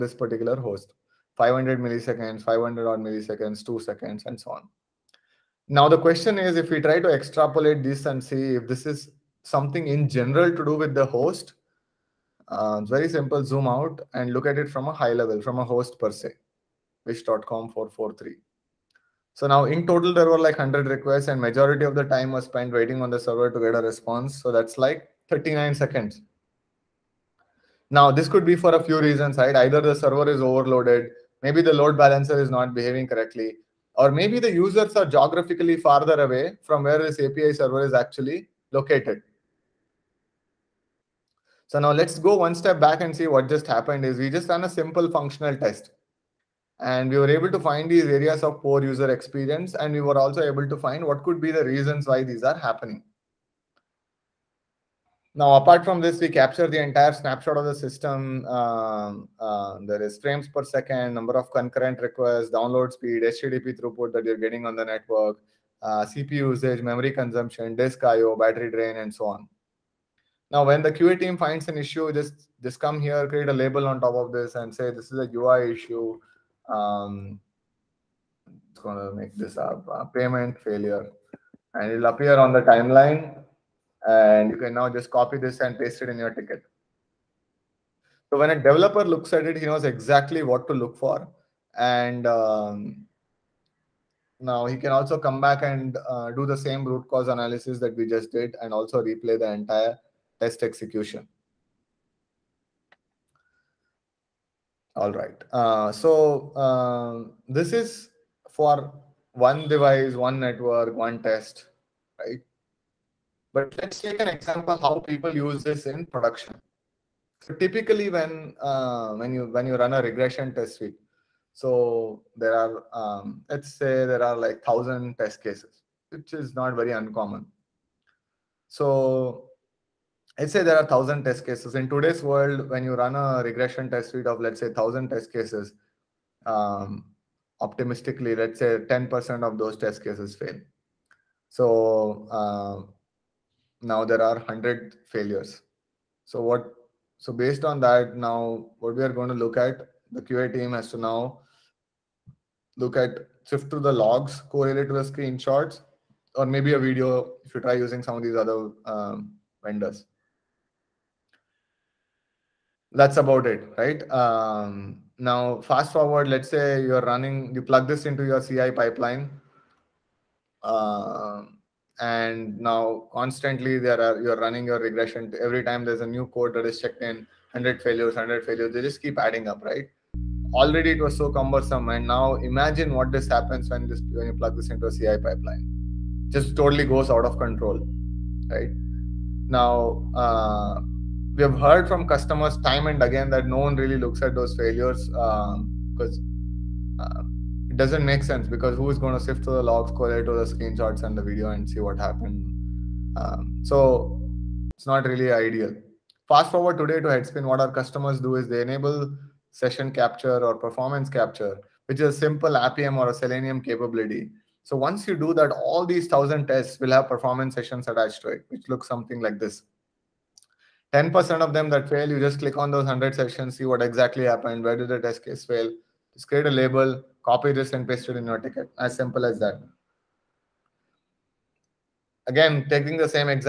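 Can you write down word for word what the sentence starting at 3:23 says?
Um, so it's not really ideal.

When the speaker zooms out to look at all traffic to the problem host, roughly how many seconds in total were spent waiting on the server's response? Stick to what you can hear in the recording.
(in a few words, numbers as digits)
39 seconds.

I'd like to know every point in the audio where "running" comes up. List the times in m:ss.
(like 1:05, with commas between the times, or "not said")
2:47, 2:54.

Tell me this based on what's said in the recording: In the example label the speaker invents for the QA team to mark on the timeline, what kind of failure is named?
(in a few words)
Payment failure.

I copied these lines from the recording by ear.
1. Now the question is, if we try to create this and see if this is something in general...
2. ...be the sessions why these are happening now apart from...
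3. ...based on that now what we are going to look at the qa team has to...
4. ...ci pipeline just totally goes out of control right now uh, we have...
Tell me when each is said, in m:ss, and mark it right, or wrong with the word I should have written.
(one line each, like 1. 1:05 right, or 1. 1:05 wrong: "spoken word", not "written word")
1. 0:05 wrong: "extrapolate", not "create"
2. 0:51 wrong: "reasons", not "sessions"
3. 2:27 right
4. 3:04 right.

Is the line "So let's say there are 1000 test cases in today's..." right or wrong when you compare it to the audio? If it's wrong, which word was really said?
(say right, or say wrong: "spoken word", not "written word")
right.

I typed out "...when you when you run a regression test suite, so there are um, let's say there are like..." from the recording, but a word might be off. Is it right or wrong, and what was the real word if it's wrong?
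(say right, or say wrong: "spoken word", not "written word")
right.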